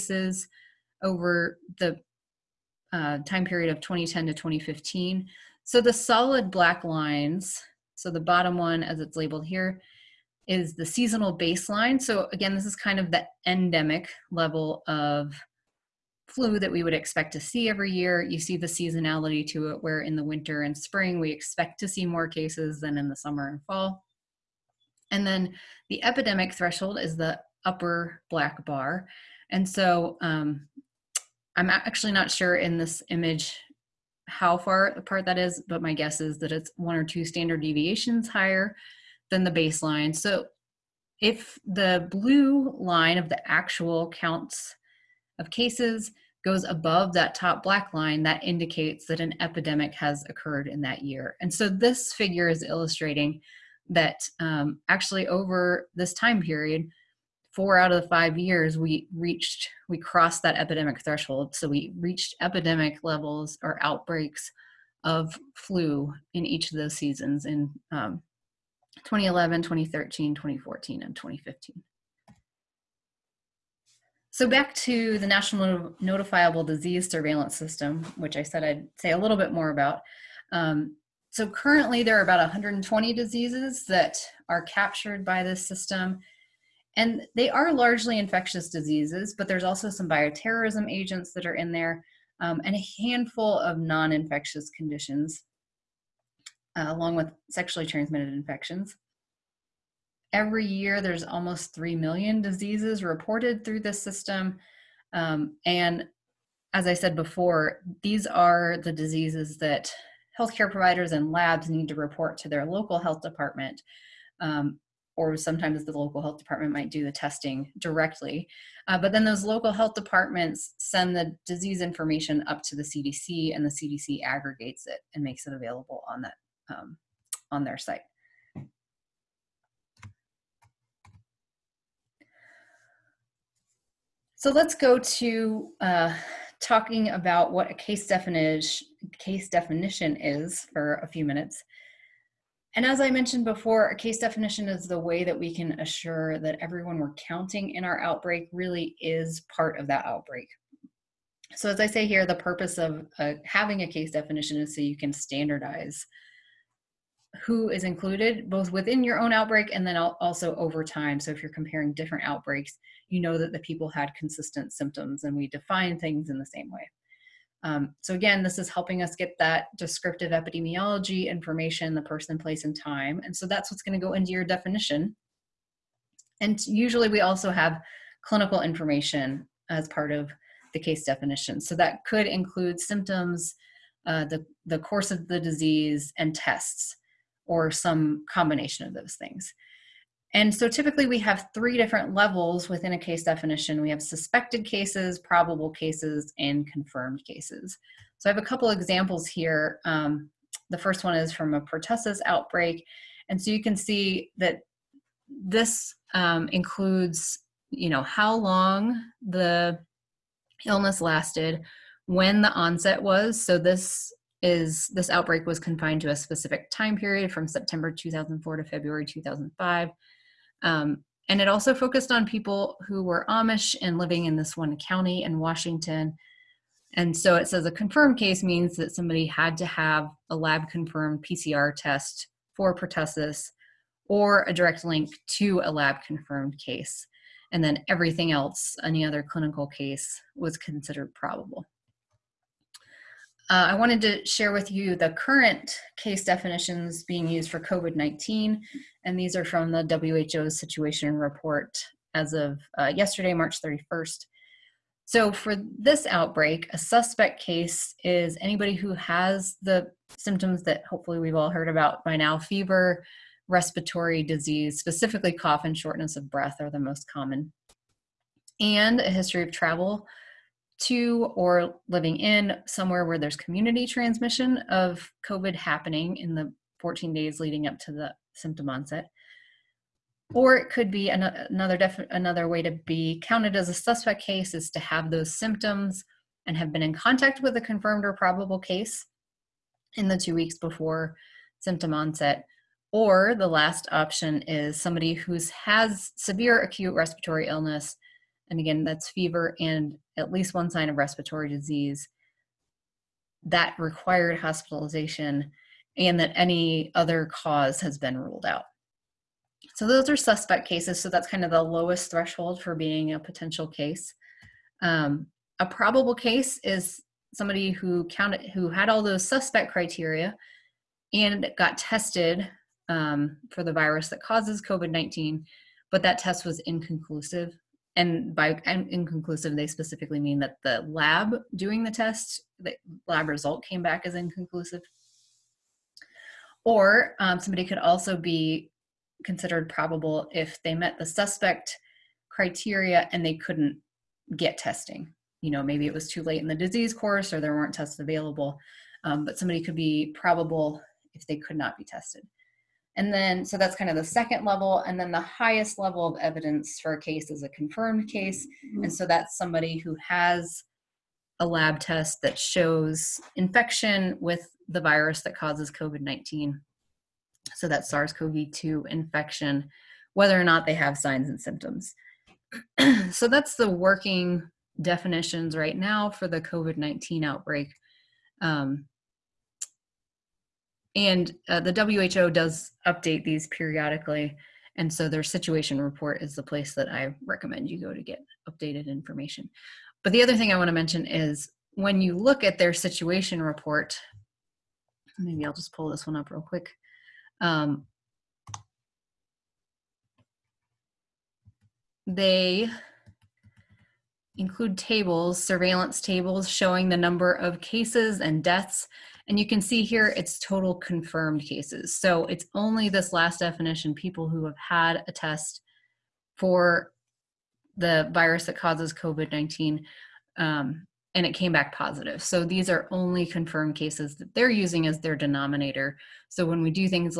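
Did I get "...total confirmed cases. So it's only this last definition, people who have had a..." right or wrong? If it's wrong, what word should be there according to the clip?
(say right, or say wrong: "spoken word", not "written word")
right.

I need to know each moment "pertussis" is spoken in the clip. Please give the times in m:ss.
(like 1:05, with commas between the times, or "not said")
3:21, 3:52.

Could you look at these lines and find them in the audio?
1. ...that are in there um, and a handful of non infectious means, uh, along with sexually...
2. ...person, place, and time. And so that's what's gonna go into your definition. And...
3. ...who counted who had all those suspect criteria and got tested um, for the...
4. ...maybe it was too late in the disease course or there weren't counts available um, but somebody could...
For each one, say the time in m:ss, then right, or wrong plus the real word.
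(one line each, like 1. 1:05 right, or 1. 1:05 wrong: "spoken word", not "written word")
1. 1:31 wrong: "conditions", not "means"
2. 2:52 right
3. 5:17 right
4. 5:45 wrong: "tests", not "counts".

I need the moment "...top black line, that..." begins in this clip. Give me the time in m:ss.
0:47.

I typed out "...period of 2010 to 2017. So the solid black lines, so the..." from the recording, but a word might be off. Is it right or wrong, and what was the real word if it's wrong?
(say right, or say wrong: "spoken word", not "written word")
wrong: "2015", not "2017".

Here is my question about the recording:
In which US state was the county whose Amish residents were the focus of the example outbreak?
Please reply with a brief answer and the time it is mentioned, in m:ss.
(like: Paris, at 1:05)
Washington, at 3:45.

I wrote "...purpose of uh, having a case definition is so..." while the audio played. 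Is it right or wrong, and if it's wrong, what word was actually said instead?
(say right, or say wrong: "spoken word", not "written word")
right.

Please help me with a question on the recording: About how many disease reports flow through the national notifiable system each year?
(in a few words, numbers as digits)
almost 3 million.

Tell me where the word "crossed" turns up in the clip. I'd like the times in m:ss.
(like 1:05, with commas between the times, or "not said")
0:59.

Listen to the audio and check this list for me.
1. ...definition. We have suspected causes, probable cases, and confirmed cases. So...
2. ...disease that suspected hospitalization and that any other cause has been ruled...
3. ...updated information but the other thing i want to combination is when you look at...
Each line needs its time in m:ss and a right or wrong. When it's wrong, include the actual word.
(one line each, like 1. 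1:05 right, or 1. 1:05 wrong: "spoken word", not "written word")
1. 3:13 wrong: "cases", not "causes"
2. 5:01 wrong: "required", not "suspected"
3. 6:28 wrong: "mention", not "combination".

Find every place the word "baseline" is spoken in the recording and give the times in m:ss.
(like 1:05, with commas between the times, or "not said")
0:11, 0:39.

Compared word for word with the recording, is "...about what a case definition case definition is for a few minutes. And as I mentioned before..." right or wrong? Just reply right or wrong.
right.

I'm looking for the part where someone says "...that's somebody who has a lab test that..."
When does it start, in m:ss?
5:59.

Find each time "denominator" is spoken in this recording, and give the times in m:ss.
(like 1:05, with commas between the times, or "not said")
7:05.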